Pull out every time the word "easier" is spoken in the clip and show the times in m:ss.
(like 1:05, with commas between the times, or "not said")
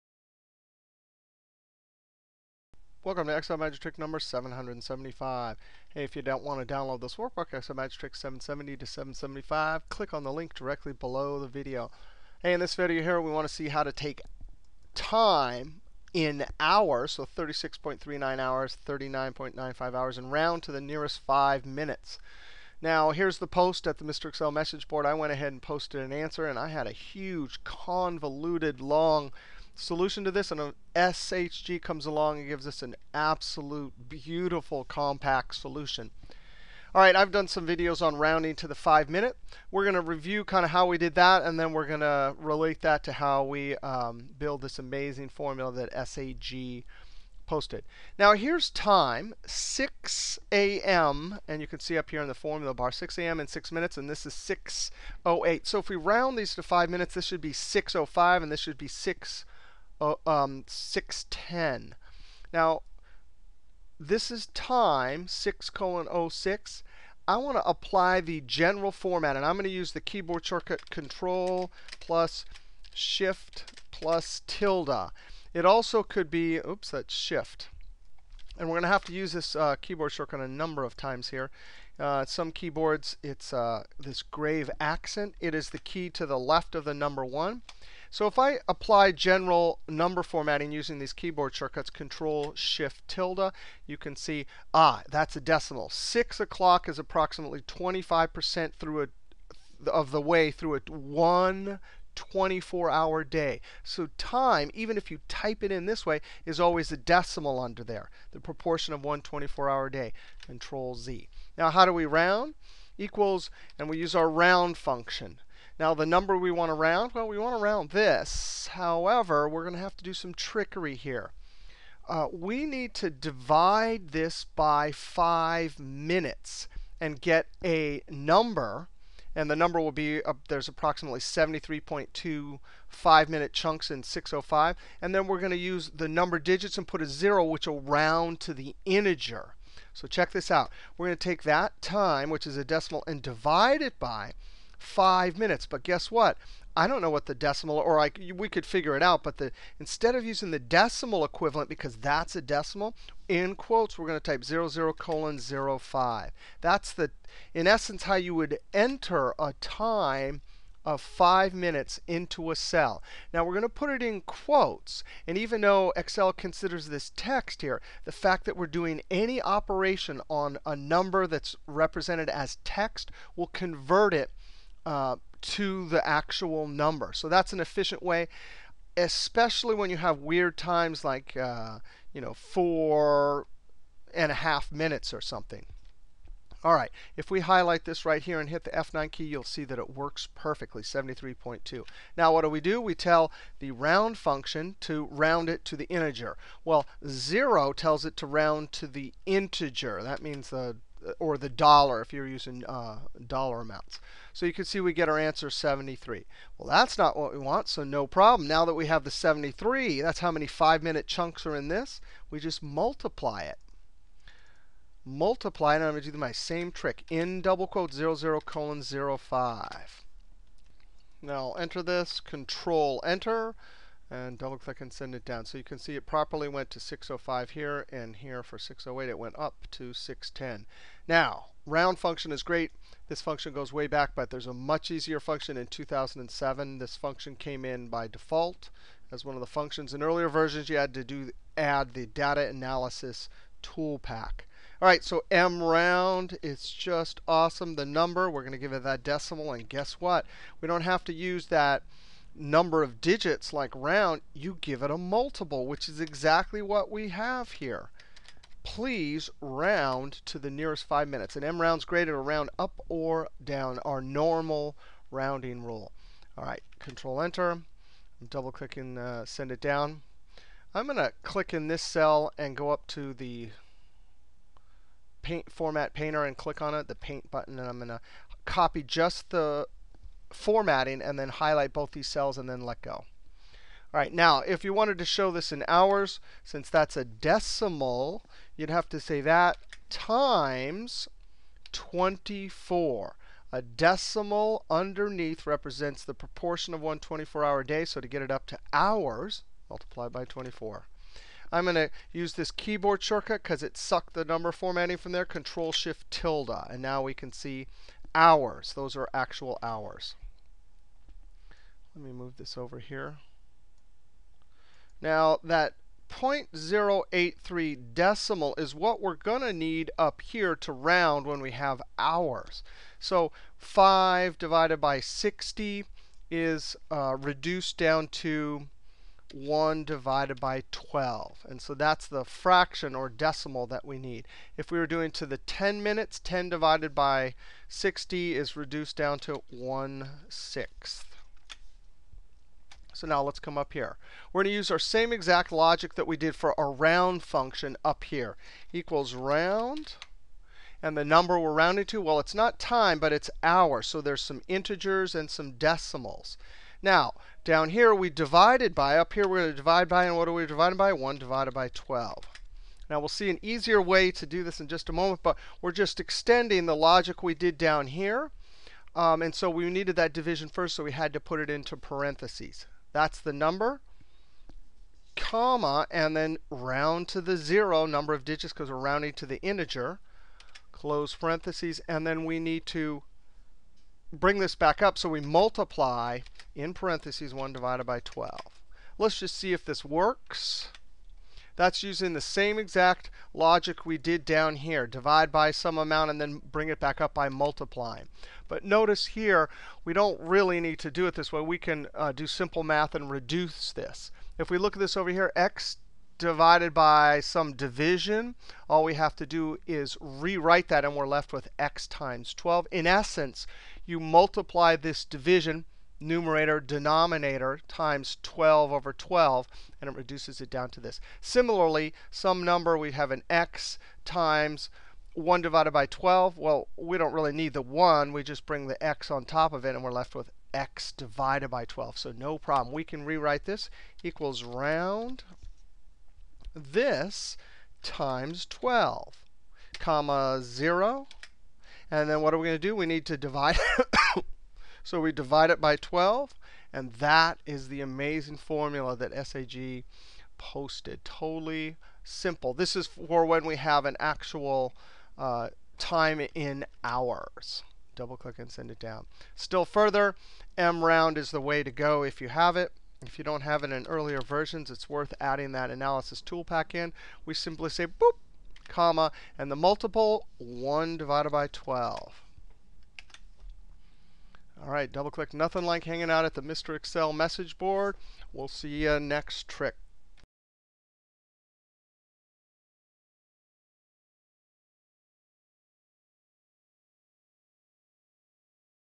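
3:54, 6:03.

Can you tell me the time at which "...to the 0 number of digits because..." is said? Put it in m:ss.
6:17.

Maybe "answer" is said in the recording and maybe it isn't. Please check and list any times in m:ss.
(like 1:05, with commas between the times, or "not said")
0:26, 3:25.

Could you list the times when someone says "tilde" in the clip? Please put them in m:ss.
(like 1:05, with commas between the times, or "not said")
1:14, 1:33, 5:05.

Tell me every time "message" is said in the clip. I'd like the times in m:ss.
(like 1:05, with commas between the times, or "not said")
0:24, 7:57.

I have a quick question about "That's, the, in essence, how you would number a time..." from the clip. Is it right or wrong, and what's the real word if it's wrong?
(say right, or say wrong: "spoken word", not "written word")
wrong: "enter", not "number".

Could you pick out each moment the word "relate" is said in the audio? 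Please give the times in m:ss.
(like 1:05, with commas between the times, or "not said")
0:42.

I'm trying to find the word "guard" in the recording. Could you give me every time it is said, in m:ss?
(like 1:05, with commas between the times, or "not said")
not said.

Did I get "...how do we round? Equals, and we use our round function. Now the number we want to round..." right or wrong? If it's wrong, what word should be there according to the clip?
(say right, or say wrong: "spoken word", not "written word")
right.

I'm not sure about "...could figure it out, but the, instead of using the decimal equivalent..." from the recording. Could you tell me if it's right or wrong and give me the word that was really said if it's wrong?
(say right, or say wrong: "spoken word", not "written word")
right.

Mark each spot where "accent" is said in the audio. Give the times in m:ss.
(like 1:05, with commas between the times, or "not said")
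1:24.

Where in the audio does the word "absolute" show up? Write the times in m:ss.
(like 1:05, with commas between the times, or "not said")
0:33.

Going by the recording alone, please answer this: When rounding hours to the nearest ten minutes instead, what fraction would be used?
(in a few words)
1/6.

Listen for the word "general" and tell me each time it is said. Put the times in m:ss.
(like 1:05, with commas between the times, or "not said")
1:08, 1:29.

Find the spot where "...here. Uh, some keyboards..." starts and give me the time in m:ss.
1:21.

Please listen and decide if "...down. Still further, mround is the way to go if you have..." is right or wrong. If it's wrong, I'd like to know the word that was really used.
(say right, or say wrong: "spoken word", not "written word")
right.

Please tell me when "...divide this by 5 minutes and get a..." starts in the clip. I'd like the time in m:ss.
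2:03.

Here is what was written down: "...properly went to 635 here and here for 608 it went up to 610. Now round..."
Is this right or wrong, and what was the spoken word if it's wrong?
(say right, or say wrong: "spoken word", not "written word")
wrong: "605", not "635".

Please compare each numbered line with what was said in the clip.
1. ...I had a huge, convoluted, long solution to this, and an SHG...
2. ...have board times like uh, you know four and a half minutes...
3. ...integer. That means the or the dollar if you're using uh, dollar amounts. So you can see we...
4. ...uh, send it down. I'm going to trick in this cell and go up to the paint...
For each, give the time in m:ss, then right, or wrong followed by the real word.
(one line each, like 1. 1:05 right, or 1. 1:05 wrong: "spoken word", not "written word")
1. 0:26 right
2. 2:59 wrong: "weird", not "board"
3. 3:19 right
4. 4:28 wrong: "click", not "trick".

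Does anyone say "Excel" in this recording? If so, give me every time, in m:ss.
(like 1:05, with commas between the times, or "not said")
0:03, 0:07, 0:24, 2:45, 7:56.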